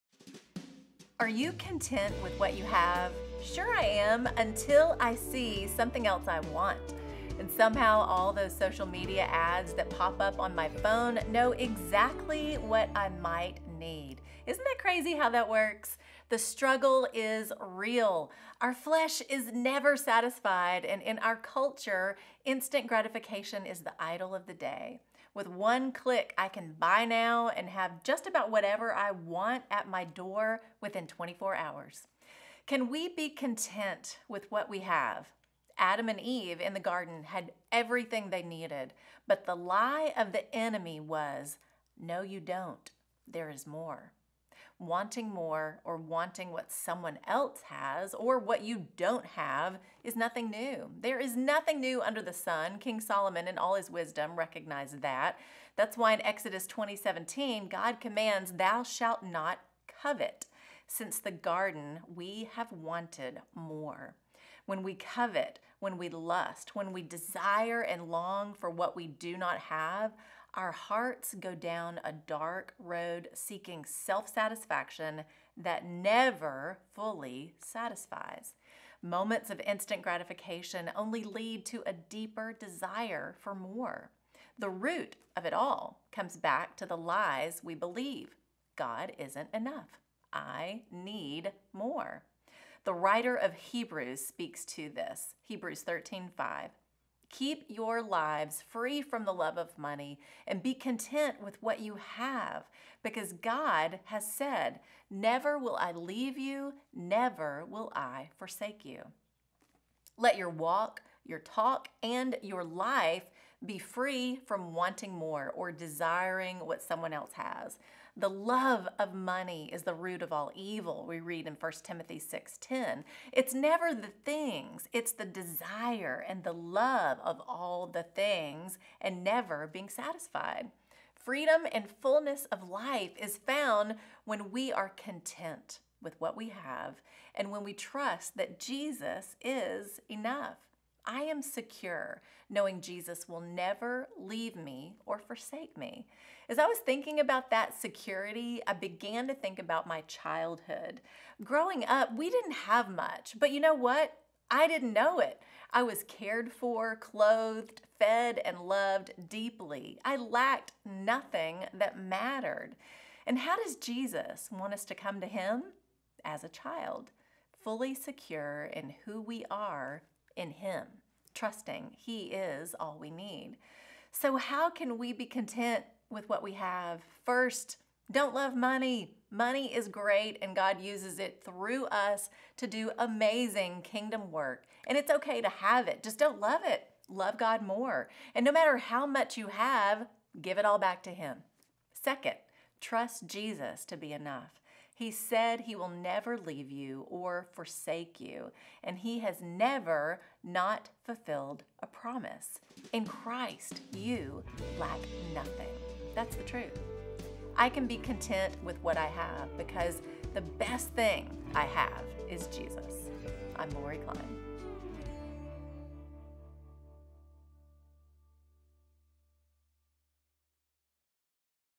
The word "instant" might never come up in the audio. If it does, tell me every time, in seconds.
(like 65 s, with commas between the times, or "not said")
22 s, 79 s.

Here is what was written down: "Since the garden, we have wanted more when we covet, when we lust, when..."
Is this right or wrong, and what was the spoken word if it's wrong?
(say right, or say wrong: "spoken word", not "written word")
right.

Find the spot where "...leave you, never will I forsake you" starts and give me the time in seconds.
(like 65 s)
105 s.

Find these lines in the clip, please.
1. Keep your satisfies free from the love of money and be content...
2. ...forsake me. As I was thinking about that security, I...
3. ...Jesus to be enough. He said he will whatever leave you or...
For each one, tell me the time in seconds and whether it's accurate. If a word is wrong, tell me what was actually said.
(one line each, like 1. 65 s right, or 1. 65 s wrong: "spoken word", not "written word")
1. 97 s wrong: "lives", not "satisfies"
2. 145 s right
3. 193 s wrong: "never", not "whatever".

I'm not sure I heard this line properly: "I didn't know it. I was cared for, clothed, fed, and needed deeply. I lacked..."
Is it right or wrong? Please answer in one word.
wrong.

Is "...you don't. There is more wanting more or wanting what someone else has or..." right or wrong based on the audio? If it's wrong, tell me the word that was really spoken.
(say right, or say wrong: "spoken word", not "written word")
right.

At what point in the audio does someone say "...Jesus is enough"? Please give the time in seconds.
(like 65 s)
138 s.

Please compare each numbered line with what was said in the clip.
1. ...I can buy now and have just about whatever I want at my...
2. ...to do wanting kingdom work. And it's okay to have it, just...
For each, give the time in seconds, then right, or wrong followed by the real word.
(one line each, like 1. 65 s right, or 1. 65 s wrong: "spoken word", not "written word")
1. 26 s right
2. 182 s wrong: "amazing", not "wanting".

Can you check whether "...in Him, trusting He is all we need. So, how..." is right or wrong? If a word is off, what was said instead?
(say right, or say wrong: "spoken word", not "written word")
right.